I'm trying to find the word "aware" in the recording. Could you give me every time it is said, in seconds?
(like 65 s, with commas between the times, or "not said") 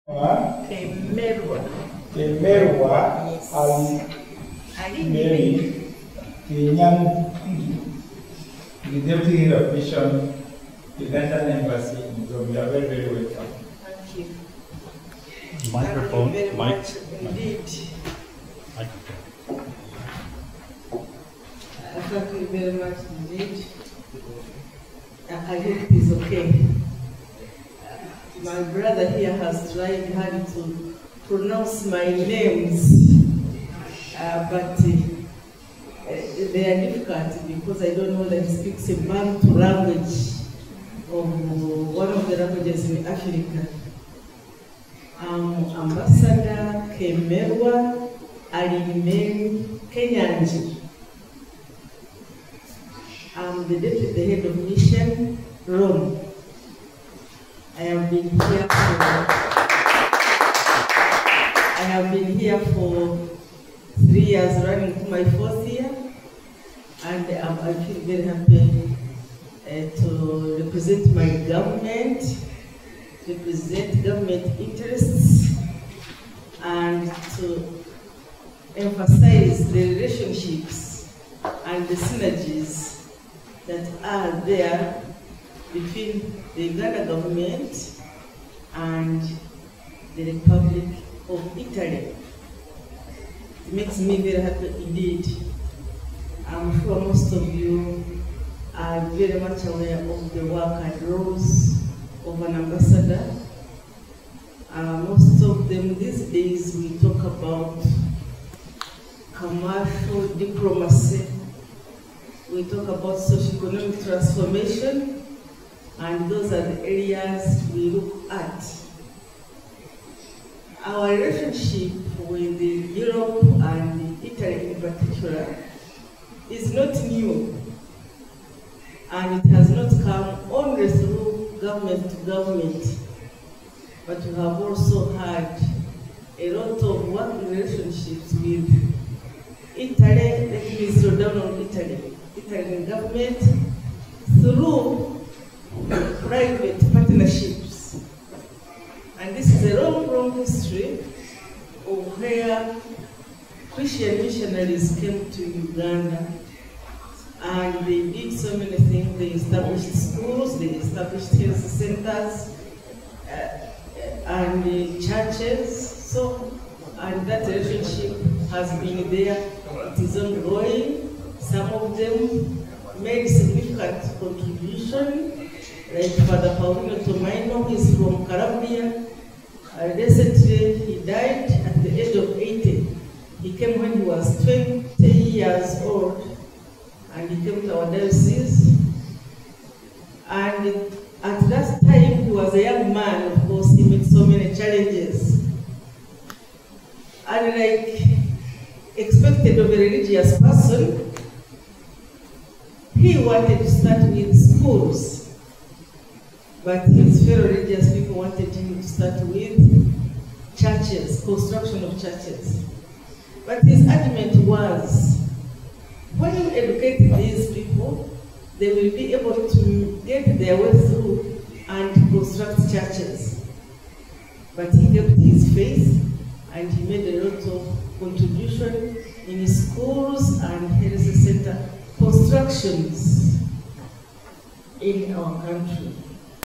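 99 s.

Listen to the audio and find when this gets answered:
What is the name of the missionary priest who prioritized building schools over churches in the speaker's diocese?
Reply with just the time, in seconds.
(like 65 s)
176 s.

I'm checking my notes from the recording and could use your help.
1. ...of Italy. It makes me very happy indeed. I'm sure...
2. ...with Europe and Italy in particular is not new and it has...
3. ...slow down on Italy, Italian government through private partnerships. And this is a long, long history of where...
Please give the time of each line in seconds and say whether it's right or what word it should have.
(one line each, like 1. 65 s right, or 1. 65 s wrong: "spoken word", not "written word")
1. 91 s right
2. 122 s right
3. 140 s right.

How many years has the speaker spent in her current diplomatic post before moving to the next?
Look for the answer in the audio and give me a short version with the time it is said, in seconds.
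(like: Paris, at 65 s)
3, at 63 s.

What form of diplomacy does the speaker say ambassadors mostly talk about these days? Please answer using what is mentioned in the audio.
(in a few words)
Commercial diplomacy.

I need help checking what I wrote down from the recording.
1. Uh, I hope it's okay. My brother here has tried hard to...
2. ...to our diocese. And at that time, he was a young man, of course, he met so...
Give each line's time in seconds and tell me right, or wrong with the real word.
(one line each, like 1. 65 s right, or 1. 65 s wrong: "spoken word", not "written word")
1. 25 s right
2. 187 s right.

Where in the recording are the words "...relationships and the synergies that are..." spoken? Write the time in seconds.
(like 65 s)
79 s.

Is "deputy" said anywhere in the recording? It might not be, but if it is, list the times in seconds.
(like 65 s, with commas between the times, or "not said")
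9 s, 53 s.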